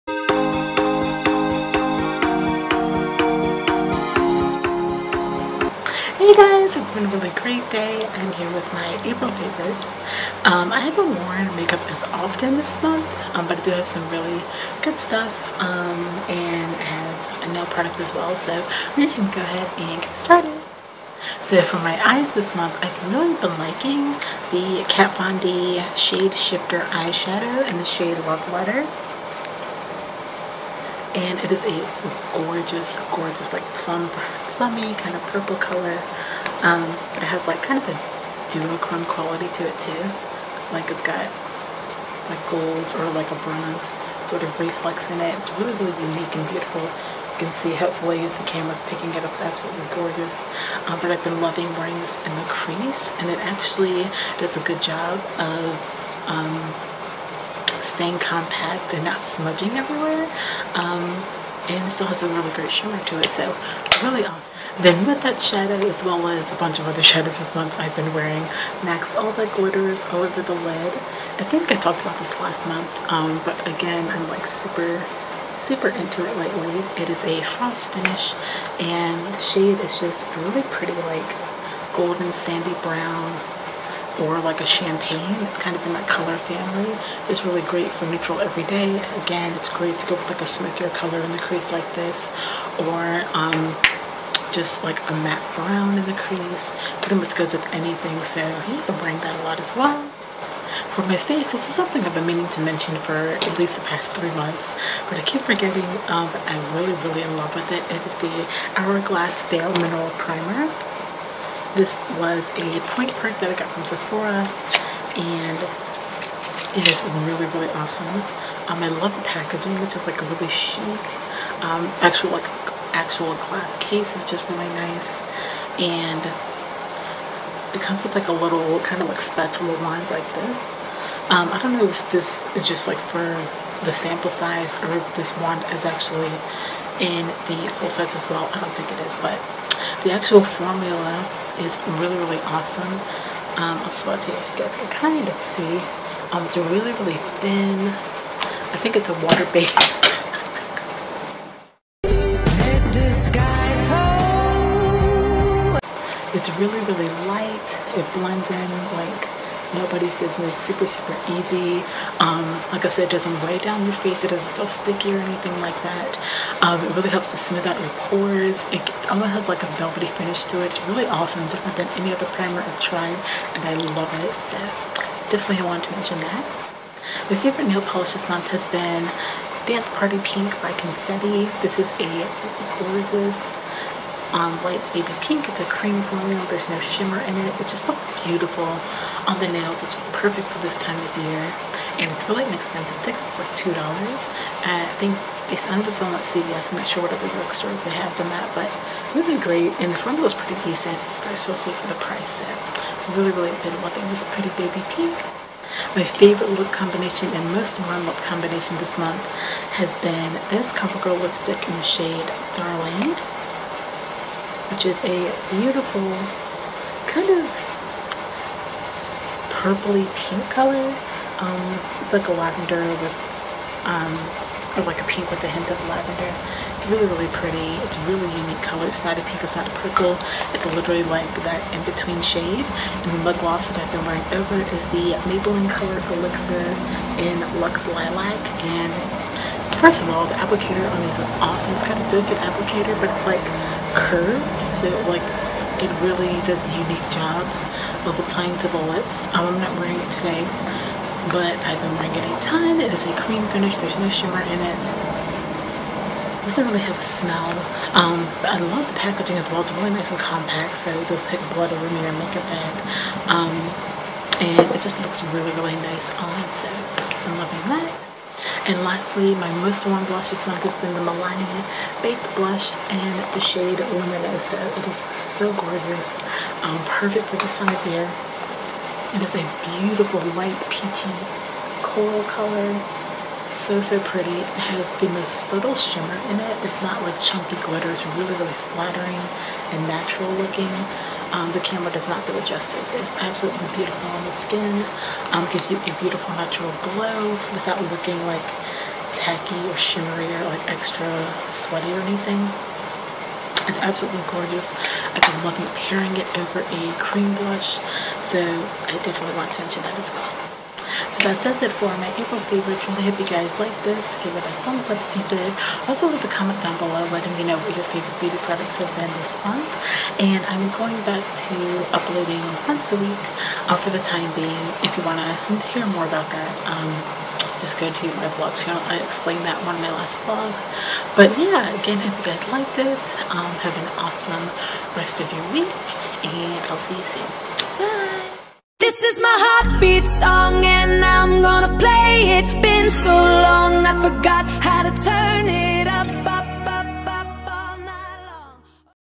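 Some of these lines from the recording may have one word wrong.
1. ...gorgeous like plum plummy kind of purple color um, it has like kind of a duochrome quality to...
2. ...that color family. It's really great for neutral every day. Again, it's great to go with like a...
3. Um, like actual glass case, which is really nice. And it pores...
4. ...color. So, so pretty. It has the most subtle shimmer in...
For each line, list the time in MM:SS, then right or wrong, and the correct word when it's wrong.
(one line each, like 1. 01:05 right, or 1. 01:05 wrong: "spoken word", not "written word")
1. 00:33 right
2. 01:25 right
3. 02:01 wrong: "comes", not "pores"
4. 04:42 right.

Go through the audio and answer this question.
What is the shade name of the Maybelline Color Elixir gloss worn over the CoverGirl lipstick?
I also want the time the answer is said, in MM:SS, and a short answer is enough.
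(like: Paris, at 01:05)
Luxe Lilac, at 03:57.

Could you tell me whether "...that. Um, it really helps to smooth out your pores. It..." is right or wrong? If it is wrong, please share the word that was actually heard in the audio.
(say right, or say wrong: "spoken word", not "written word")
right.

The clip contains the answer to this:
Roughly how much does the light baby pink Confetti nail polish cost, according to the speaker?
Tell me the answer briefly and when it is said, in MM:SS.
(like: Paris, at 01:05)
$2, at 03:13.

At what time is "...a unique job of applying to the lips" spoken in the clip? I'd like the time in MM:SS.
04:06.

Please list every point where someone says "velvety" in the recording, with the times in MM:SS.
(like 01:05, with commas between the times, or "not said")
02:49.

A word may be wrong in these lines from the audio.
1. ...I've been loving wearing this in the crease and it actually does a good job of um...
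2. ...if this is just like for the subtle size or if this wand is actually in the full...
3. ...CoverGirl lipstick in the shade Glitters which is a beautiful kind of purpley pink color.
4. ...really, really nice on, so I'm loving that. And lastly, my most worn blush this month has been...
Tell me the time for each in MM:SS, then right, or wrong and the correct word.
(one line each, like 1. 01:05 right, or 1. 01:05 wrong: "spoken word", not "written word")
1. 00:51 right
2. 02:11 wrong: "sample", not "subtle"
3. 03:30 wrong: "Darling", not "Glitters"
4. 04:25 right.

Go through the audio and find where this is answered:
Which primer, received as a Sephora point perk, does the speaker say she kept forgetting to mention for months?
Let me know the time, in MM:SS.
01:48.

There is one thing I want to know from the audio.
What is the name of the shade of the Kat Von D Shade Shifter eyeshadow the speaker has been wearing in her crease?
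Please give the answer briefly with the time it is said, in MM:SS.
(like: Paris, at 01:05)
Love Letter, at 00:28.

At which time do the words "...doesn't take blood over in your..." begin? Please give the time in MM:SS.
04:21.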